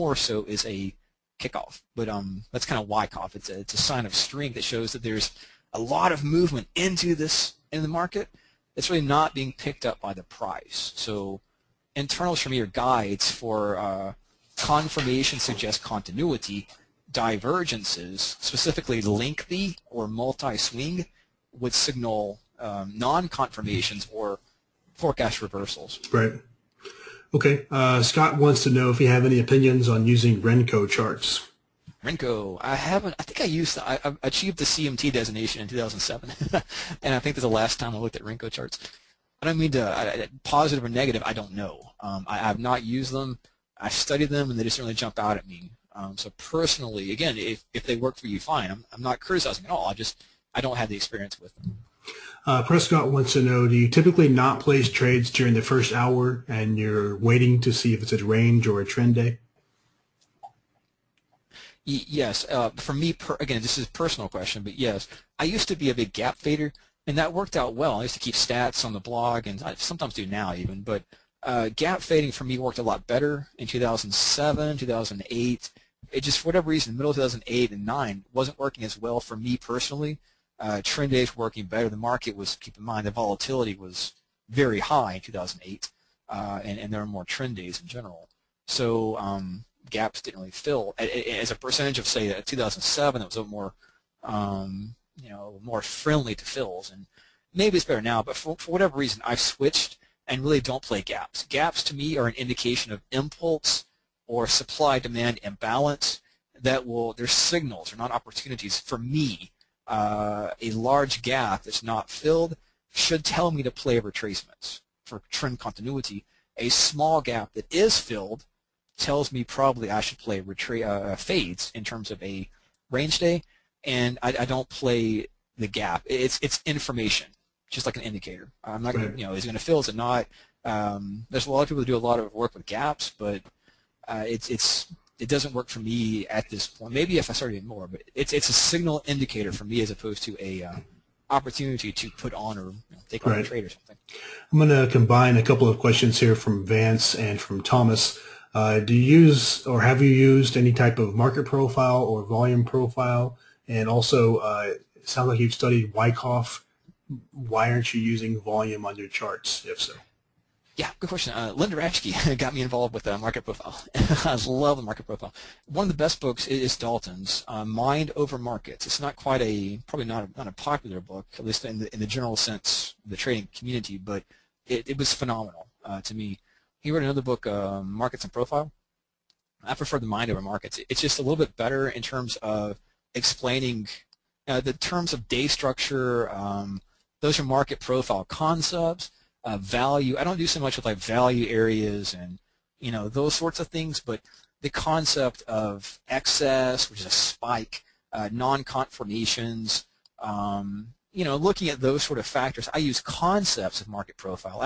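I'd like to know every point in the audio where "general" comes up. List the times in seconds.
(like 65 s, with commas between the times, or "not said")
87 s, 172 s.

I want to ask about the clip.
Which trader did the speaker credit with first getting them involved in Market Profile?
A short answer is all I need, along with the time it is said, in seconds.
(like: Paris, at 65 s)
Linda Raschke, at 161 s.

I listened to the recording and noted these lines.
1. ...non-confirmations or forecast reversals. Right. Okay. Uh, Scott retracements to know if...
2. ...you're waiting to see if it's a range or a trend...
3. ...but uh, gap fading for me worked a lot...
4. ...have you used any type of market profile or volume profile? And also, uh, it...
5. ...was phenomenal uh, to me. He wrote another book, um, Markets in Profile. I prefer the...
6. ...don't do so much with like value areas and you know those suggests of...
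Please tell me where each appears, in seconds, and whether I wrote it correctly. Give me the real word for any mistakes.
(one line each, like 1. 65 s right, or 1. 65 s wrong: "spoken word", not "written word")
1. 22 s wrong: "wants", not "retracements"
2. 56 s right
3. 70 s right
4. 149 s right
5. 174 s right
6. 190 s wrong: "sorts", not "suggests".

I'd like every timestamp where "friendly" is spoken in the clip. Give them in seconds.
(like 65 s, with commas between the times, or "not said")
95 s.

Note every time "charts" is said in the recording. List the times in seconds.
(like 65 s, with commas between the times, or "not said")
30 s, 38 s, 159 s.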